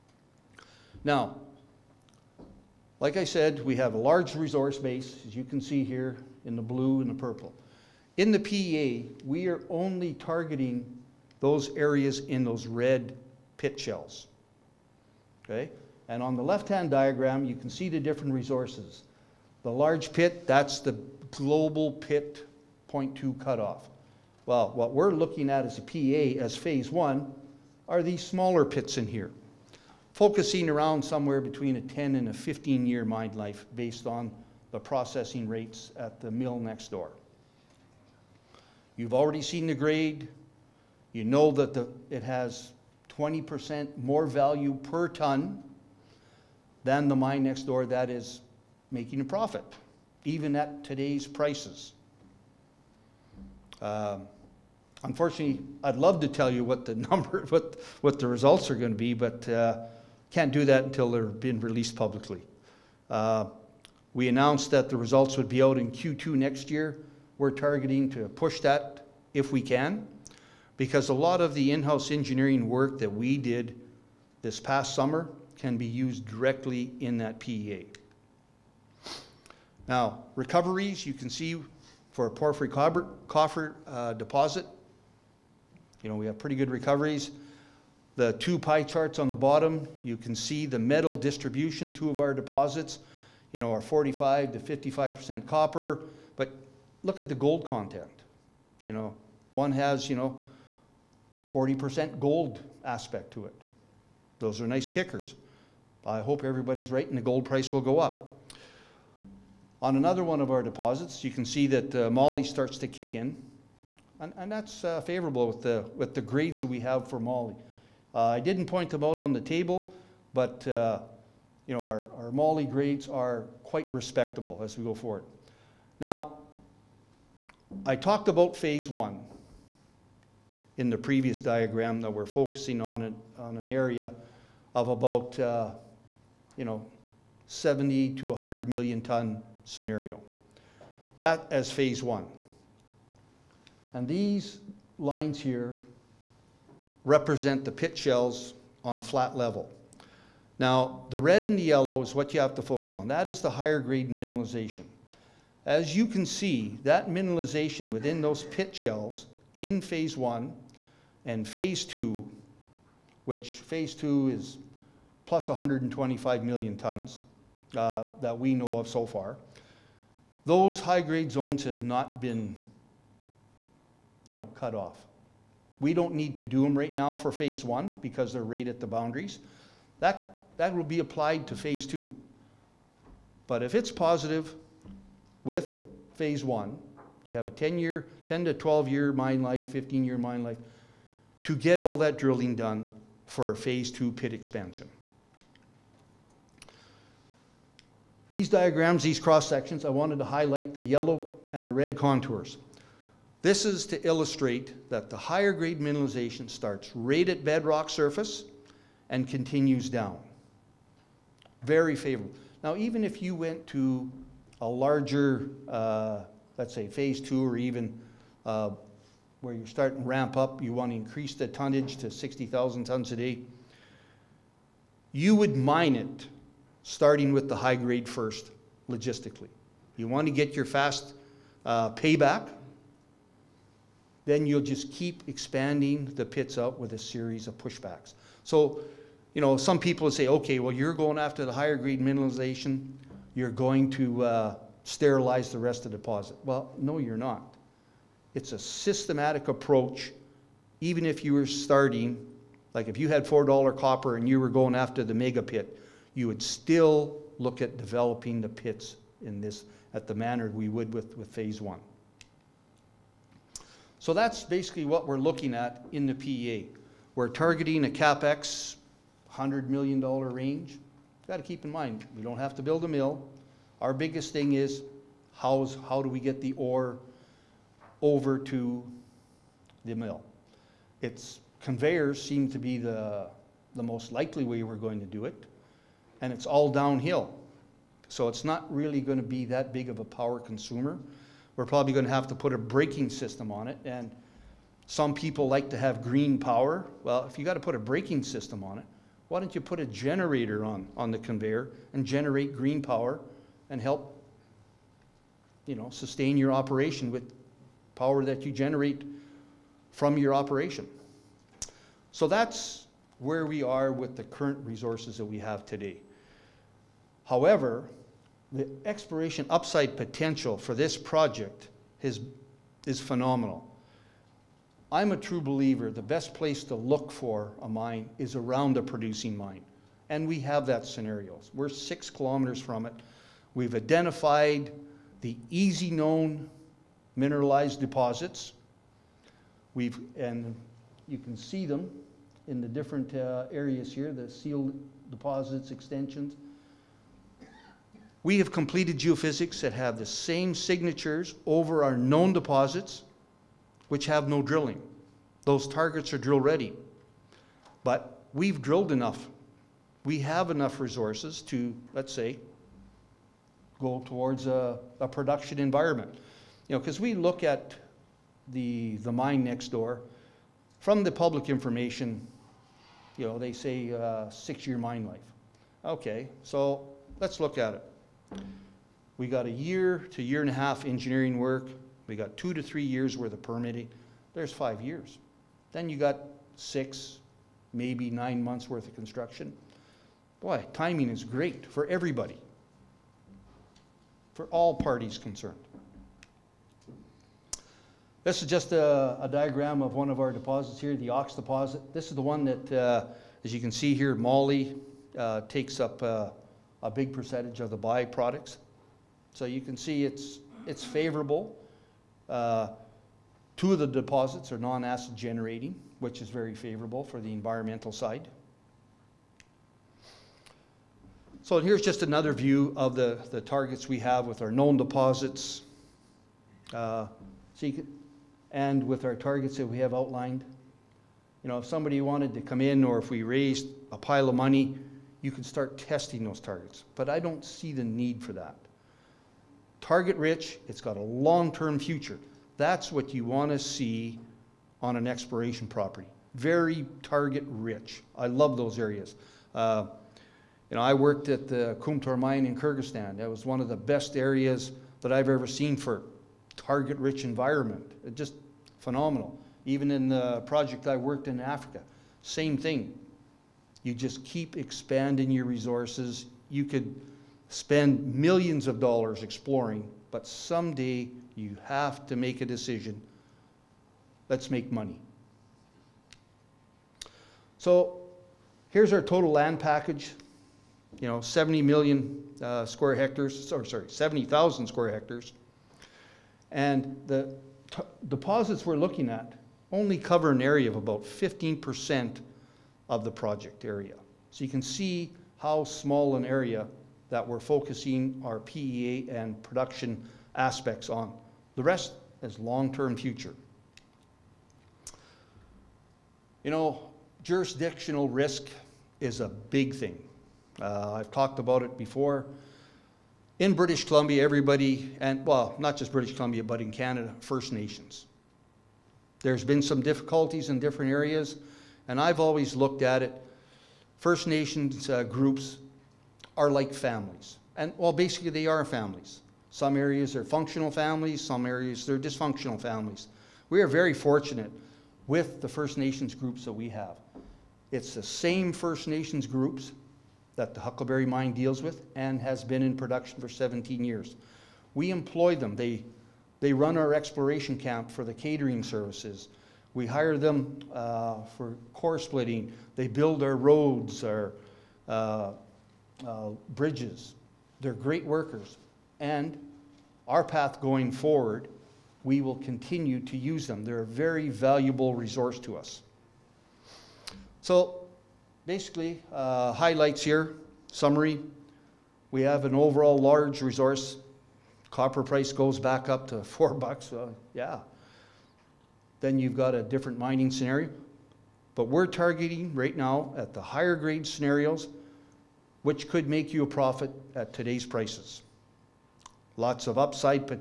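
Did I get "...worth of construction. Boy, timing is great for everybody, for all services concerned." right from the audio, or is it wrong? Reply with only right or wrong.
wrong.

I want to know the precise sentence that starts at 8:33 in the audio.
In British Columbia, everybody, and well, not just British Columbia, but in Canada, First Nations.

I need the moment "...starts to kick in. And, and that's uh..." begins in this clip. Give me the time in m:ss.
1:52.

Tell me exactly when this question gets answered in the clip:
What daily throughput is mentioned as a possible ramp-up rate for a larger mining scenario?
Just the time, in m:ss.
3:42.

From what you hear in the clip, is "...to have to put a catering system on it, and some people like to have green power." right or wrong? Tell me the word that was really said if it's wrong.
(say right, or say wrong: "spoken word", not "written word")
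wrong: "braking", not "catering".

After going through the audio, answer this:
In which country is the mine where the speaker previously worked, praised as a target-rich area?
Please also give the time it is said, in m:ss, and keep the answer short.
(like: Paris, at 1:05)
Kyrgyzstan, at 7:32.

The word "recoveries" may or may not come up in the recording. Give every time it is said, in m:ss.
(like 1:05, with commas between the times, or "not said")
1:20, 1:26.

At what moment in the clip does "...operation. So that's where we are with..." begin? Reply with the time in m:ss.
5:10.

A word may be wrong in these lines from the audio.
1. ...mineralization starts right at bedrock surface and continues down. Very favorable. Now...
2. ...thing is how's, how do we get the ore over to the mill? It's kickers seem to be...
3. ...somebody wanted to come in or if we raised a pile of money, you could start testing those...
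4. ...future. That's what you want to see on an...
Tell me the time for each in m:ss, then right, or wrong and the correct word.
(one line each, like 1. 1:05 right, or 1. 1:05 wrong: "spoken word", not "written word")
1. 3:25 right
2. 4:34 wrong: "conveyors", not "kickers"
3. 7:11 right
4. 7:21 right.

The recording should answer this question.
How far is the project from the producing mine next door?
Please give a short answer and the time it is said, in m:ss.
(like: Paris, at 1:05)
6 kilometers, at 5:31.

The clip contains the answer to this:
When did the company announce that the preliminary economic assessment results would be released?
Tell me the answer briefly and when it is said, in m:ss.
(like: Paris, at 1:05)
Q2 next year, at 1:05.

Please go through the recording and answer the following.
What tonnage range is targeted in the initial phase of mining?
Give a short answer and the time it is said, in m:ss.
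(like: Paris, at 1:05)
70 to 100 million tons, at 2:17.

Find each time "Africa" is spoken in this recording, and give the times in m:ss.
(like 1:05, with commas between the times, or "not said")
7:41.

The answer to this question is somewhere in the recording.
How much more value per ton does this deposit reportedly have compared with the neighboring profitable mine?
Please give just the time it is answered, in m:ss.
0:43.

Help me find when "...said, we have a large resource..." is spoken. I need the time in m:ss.
0:03.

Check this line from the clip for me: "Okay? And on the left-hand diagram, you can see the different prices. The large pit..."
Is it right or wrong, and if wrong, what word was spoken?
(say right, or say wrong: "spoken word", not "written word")
wrong: "resources", not "prices".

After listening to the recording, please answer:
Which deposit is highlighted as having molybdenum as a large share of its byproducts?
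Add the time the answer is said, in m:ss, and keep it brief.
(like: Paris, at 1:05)
Ox deposit, at 6:41.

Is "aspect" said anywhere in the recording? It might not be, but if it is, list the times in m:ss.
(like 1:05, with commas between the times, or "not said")
1:42, 8:20.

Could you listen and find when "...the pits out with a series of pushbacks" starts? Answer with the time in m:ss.
3:56.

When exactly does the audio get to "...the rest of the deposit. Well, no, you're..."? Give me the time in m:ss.
4:05.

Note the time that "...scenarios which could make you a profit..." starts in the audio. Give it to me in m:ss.
9:44.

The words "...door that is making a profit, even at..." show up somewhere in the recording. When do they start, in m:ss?
0:47.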